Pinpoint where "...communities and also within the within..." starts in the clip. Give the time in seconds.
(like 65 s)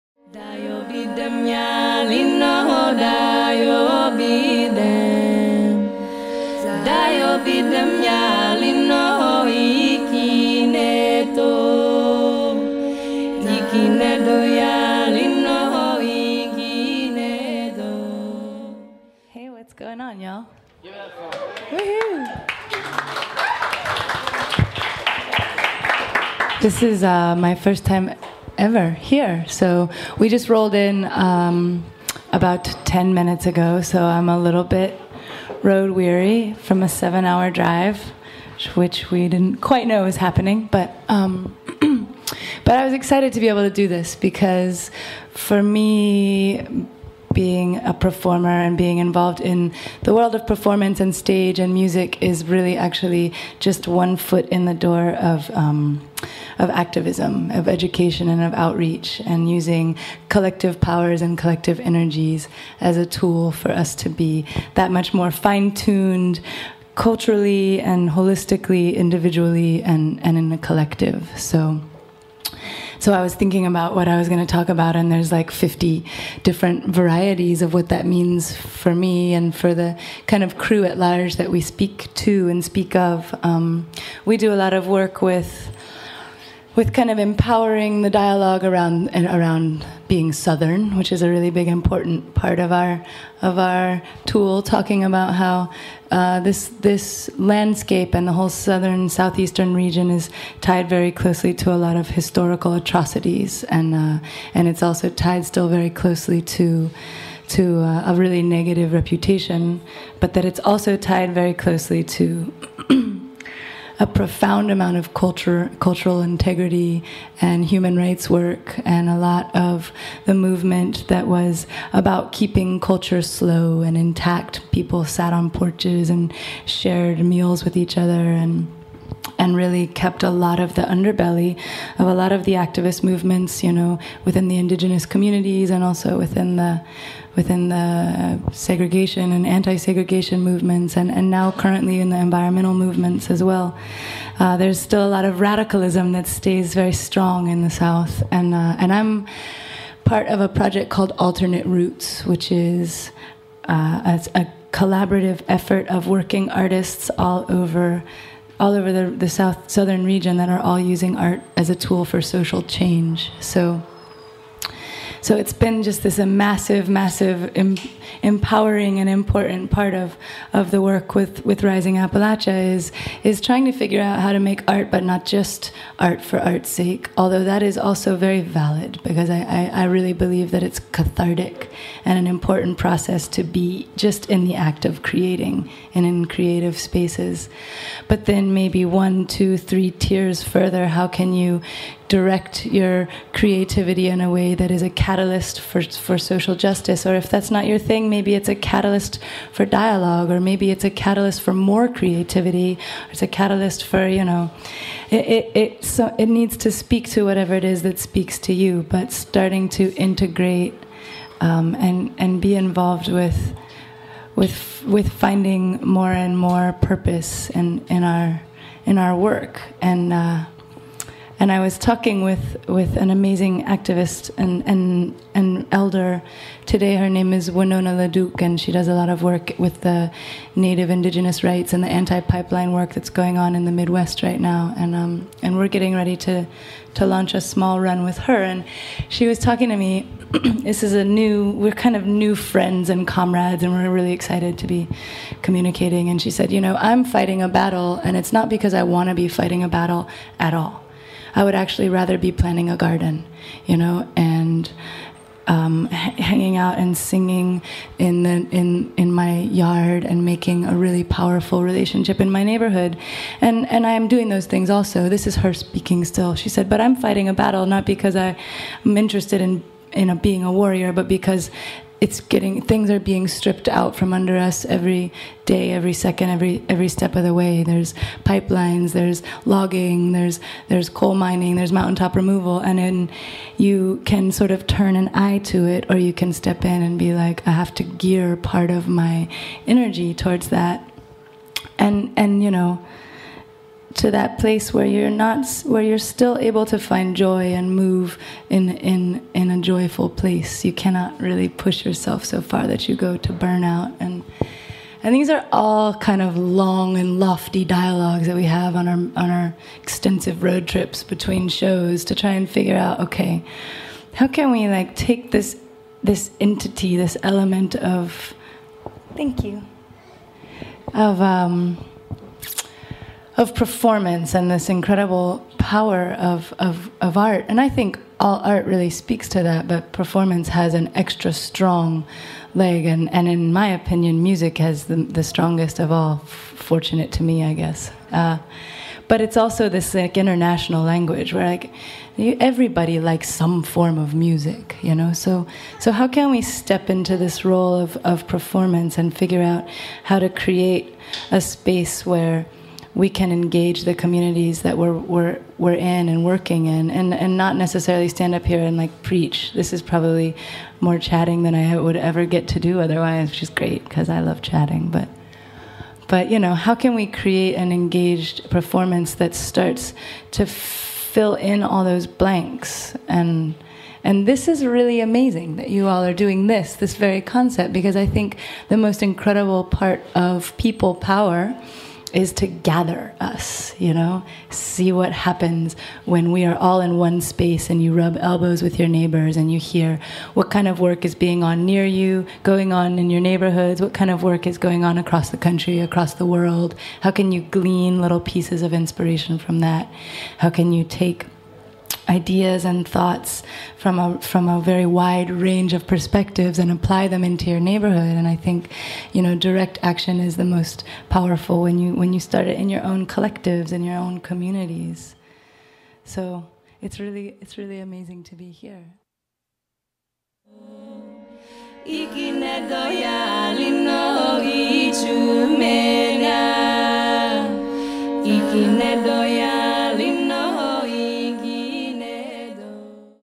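135 s.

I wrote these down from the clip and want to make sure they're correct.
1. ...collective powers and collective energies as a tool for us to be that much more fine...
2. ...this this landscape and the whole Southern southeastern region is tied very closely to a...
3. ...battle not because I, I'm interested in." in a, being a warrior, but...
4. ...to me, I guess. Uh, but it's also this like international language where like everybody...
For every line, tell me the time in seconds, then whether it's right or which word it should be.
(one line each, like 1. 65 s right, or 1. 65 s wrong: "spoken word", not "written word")
1. 60 s right
2. 96 s right
3. 267 s right
4. 337 s right.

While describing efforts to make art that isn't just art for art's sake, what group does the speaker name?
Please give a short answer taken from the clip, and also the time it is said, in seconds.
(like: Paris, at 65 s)
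Rising Appalachia, at 171 s.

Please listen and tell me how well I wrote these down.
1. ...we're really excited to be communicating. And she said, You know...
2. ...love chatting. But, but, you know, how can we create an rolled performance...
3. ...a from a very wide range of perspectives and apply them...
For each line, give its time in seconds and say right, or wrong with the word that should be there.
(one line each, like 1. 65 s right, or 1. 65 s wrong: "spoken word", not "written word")
1. 243 s right
2. 364 s wrong: "engaged", not "rolled"
3. 403 s right.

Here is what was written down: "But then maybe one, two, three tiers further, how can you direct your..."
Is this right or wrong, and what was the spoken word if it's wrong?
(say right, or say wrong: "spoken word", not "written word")
right.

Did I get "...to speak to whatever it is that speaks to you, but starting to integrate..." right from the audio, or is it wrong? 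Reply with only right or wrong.
right.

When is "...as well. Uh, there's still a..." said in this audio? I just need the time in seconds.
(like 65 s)
143 s.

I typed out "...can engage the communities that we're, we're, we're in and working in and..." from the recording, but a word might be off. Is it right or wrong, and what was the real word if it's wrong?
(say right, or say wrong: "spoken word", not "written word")
right.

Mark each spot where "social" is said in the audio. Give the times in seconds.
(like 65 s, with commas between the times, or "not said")
162 s, 196 s.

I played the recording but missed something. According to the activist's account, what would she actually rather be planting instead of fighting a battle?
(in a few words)
A garden.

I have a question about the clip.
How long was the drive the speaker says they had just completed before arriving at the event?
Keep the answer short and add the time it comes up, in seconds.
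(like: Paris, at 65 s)
7 hours, at 36 s.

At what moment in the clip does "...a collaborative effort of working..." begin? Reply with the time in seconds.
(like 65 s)
154 s.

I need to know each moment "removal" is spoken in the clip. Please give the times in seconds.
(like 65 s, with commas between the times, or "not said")
282 s.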